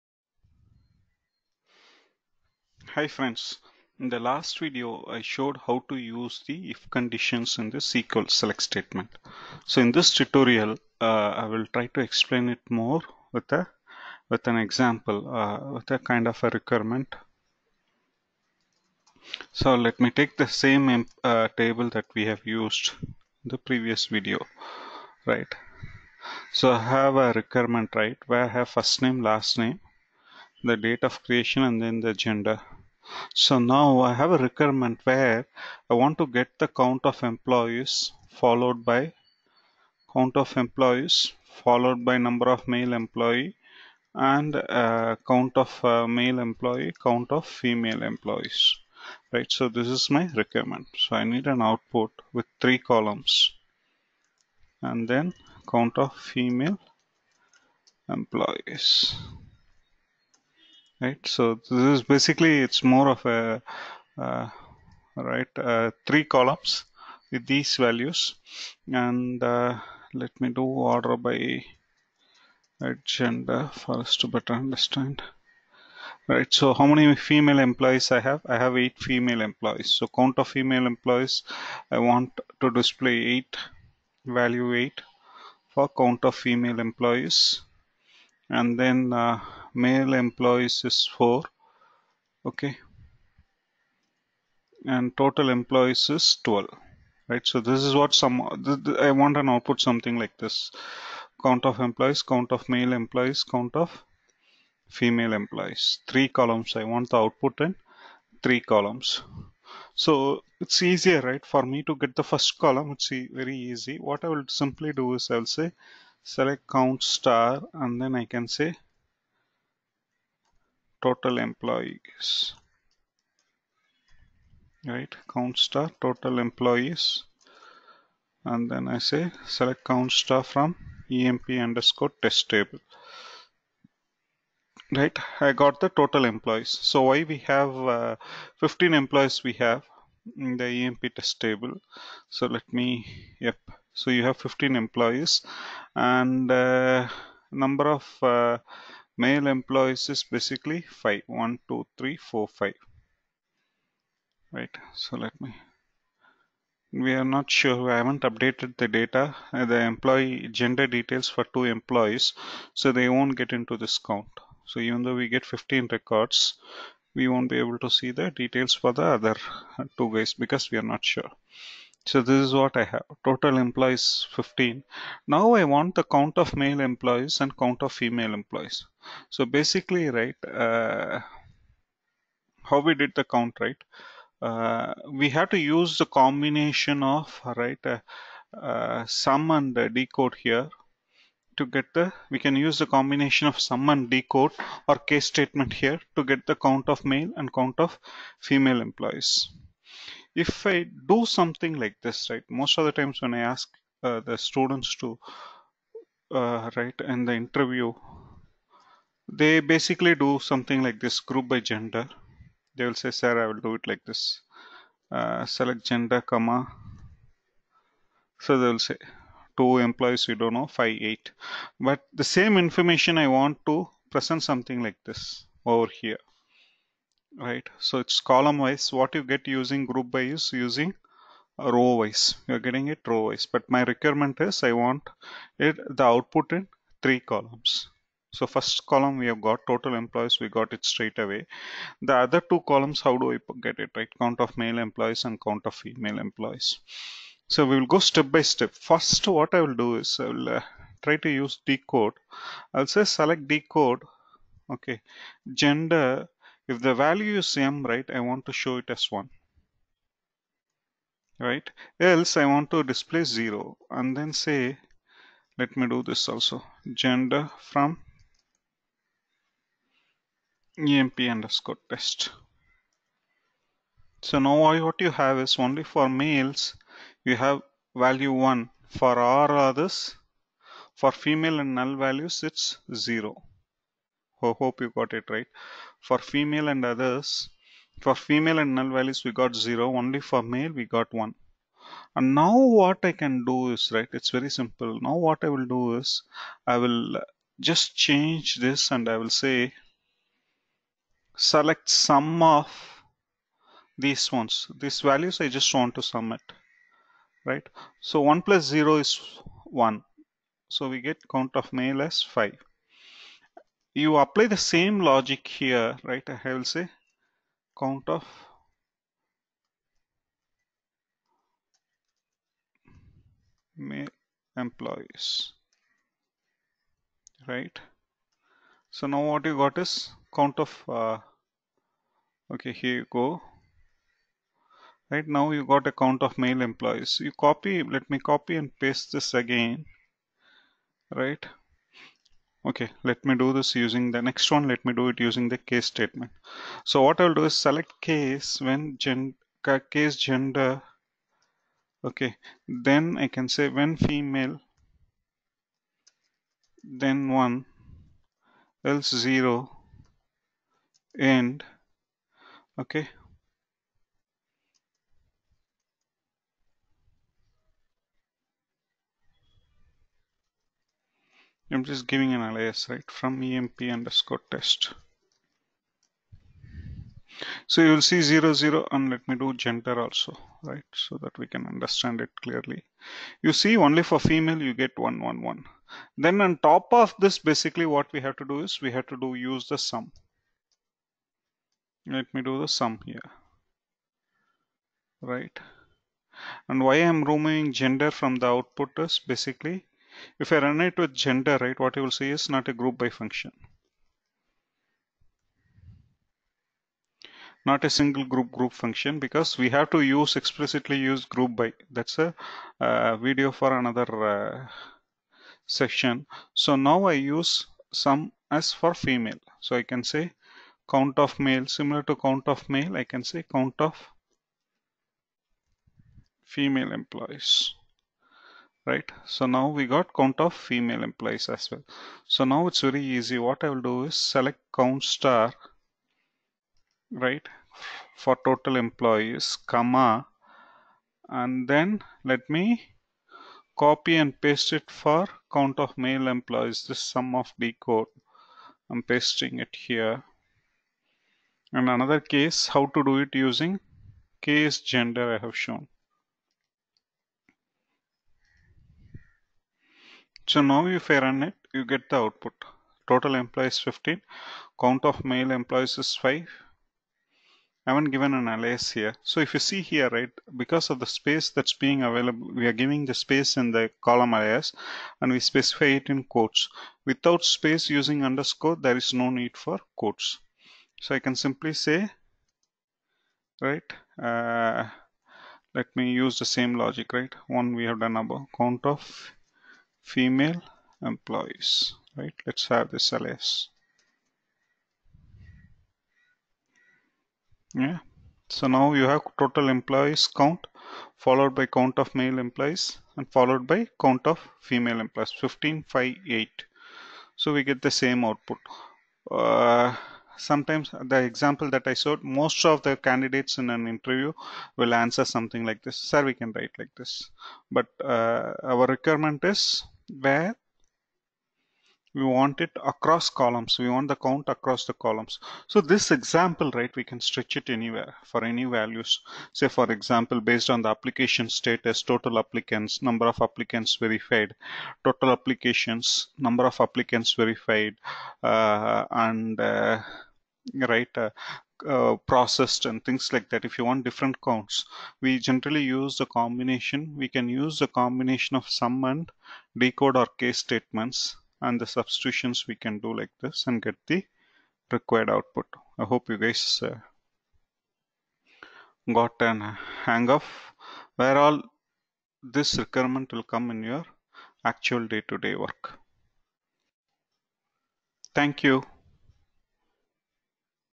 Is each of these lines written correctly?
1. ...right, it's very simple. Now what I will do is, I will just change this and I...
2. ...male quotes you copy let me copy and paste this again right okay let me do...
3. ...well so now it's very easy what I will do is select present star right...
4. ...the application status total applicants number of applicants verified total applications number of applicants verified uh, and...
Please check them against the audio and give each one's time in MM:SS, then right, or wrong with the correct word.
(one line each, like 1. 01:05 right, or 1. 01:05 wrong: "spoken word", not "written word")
1. 04:53 right
2. 05:36 wrong: "employees", not "quotes"
3. 07:11 wrong: "count", not "present"
4. 08:50 right.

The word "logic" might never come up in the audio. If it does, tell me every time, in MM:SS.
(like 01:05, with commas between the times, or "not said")
05:15, 08:06.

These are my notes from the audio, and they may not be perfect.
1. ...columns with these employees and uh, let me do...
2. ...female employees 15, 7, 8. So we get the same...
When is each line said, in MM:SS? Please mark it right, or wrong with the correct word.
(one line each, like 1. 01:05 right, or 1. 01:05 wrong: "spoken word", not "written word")
1. 01:06 wrong: "values", not "employees"
2. 08:24 wrong: "5", not "7".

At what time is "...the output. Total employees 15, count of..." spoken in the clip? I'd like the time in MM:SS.
07:42.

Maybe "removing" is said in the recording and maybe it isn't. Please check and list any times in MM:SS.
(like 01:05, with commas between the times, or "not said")
06:37.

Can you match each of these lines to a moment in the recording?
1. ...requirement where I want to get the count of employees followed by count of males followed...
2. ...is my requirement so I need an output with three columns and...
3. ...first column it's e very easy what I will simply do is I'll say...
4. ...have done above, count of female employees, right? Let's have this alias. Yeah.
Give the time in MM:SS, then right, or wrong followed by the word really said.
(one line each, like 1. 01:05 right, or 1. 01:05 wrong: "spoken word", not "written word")
1. 00:34 wrong: "employees", not "males"
2. 00:49 right
3. 01:52 right
4. 08:07 right.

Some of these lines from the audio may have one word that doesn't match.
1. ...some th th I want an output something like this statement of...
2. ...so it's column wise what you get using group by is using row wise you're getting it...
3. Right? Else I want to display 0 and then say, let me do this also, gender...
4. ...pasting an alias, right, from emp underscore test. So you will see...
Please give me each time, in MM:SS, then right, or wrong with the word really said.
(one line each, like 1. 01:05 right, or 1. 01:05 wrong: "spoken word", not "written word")
1. 01:38 wrong: "count", not "statement"
2. 03:47 right
3. 04:21 right
4. 06:12 wrong: "giving", not "pasting".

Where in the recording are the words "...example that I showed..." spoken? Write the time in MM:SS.
08:31.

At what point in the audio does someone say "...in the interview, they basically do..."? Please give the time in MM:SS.
03:27.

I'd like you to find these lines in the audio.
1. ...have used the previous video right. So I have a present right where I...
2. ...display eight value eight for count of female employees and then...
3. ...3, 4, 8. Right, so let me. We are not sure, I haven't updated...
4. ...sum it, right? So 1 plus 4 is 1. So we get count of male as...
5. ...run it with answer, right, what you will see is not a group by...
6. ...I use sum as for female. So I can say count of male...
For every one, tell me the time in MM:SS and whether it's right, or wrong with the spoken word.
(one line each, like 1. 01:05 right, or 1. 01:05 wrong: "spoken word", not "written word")
1. 00:22 wrong: "requirement", not "present"
2. 01:22 right
3. 02:31 wrong: "5", not "8"
4. 05:06 wrong: "0", not "4"
5. 06:40 wrong: "gender", not "answer"
6. 06:57 right.